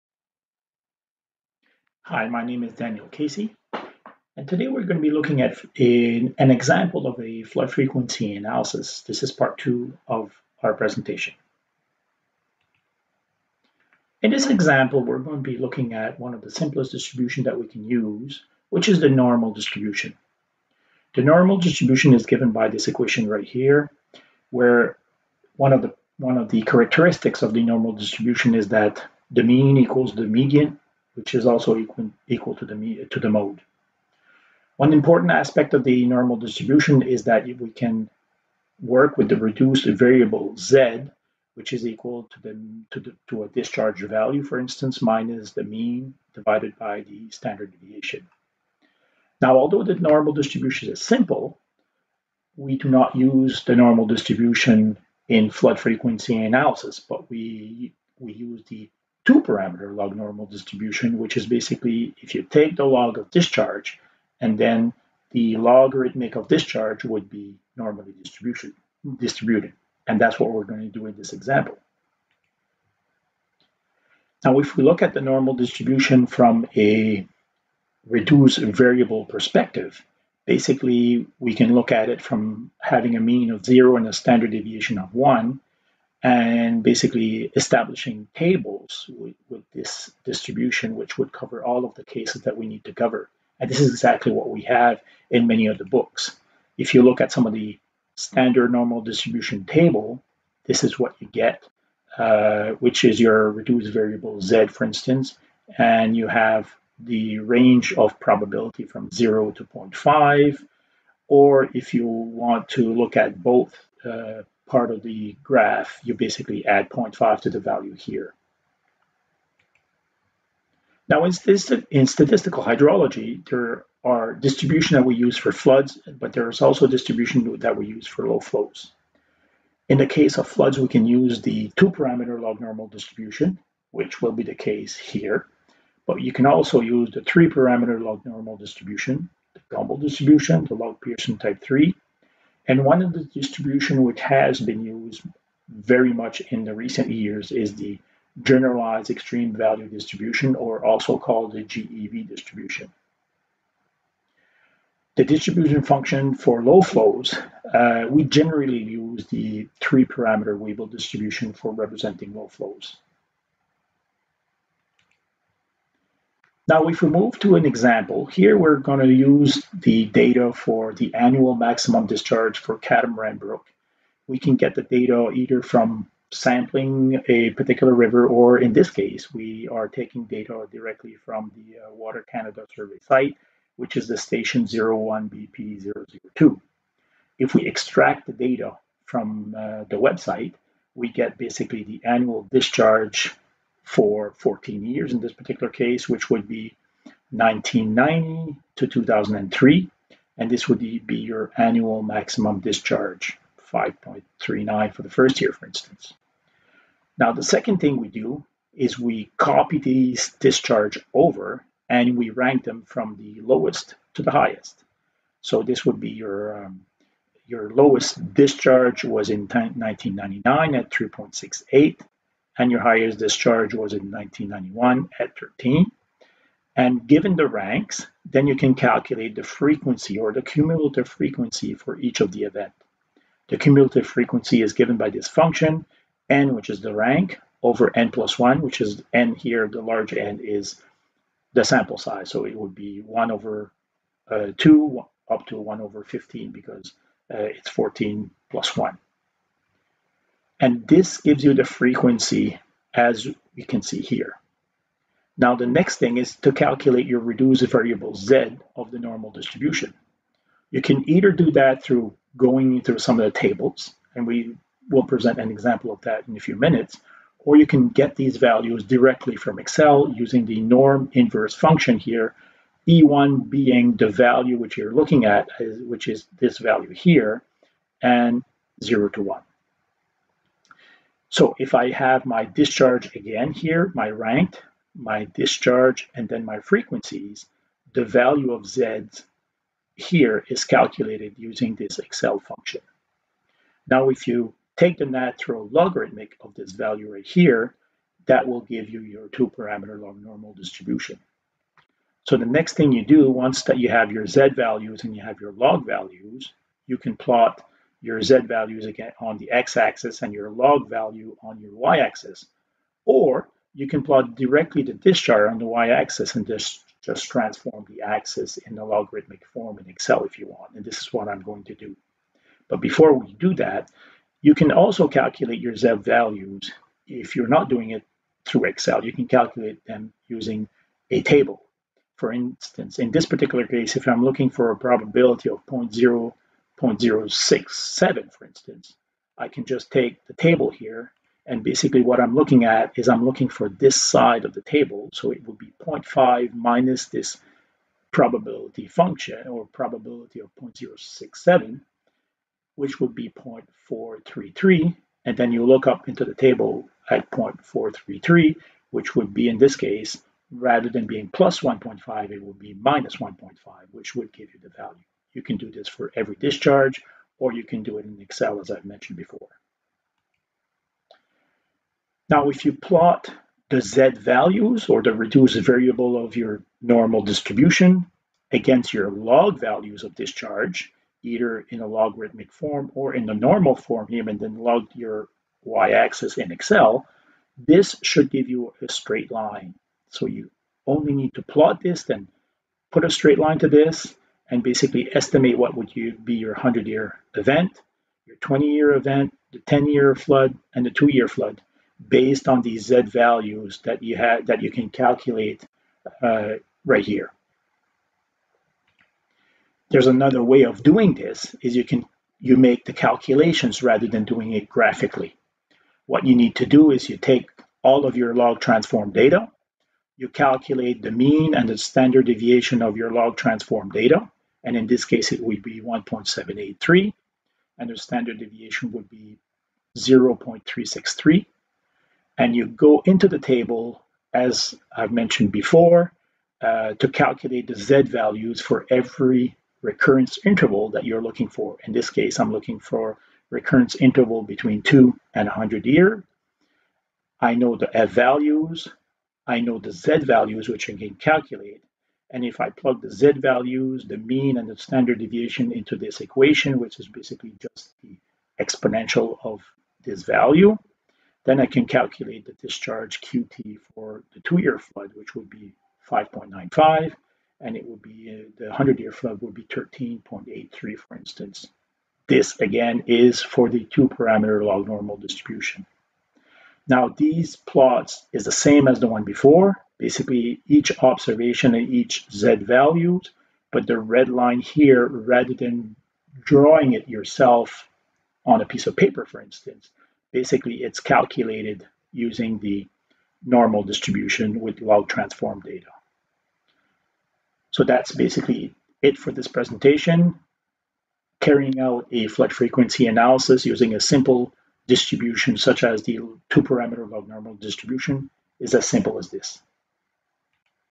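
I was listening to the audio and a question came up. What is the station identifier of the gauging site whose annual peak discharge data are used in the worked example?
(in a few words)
01BP002.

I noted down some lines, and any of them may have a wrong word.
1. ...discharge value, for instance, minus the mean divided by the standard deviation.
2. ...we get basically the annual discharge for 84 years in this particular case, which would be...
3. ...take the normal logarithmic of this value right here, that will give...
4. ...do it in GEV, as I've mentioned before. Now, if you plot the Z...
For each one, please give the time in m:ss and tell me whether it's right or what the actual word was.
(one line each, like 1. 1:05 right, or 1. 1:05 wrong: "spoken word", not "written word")
1. 0:43 right
2. 3:10 wrong: "14", not "84"
3. 4:54 wrong: "natural", not "normal"
4. 6:07 wrong: "Excel", not "GEV".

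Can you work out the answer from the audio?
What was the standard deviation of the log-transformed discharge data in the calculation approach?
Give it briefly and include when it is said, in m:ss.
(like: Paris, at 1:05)
0.363, at 7:09.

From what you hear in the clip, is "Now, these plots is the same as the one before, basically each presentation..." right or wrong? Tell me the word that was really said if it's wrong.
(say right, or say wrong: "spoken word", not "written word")
wrong: "observation", not "presentation".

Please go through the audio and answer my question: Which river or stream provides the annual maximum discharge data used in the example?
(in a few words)
Catamaran Brook.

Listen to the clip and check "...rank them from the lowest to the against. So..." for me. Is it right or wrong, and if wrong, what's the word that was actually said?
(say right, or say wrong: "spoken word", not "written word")
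wrong: "highest", not "against".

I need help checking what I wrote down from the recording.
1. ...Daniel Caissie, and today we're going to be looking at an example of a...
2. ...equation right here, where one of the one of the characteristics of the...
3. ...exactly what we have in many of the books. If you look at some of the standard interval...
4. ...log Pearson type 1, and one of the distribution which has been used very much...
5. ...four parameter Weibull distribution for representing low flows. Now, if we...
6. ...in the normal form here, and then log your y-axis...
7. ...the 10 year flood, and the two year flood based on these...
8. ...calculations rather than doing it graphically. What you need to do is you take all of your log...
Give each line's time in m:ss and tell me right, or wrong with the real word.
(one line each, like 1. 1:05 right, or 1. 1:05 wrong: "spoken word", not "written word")
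1. 0:02 right
2. 0:22 right
3. 1:33 wrong: "normal", not "interval"
4. 2:20 wrong: "3", not "1"
5. 2:39 wrong: "three", not "four"
6. 6:23 right
7. 6:39 right
8. 6:52 right.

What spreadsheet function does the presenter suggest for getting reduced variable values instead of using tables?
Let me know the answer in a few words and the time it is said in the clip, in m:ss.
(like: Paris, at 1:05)
Norm inverse, at 4:30.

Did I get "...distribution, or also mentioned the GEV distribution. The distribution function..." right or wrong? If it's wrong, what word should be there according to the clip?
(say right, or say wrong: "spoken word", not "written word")
wrong: "called", not "mentioned".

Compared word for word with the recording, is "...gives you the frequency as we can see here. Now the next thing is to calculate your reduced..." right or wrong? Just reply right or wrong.
right.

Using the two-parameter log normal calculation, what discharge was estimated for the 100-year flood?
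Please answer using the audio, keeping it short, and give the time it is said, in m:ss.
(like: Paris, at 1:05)
13.83, at 7:49.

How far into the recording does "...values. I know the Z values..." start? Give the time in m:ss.
7:28.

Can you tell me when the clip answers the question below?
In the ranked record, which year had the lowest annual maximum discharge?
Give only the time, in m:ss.
3:39.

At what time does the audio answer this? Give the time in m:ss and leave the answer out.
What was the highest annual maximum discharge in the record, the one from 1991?
3:45.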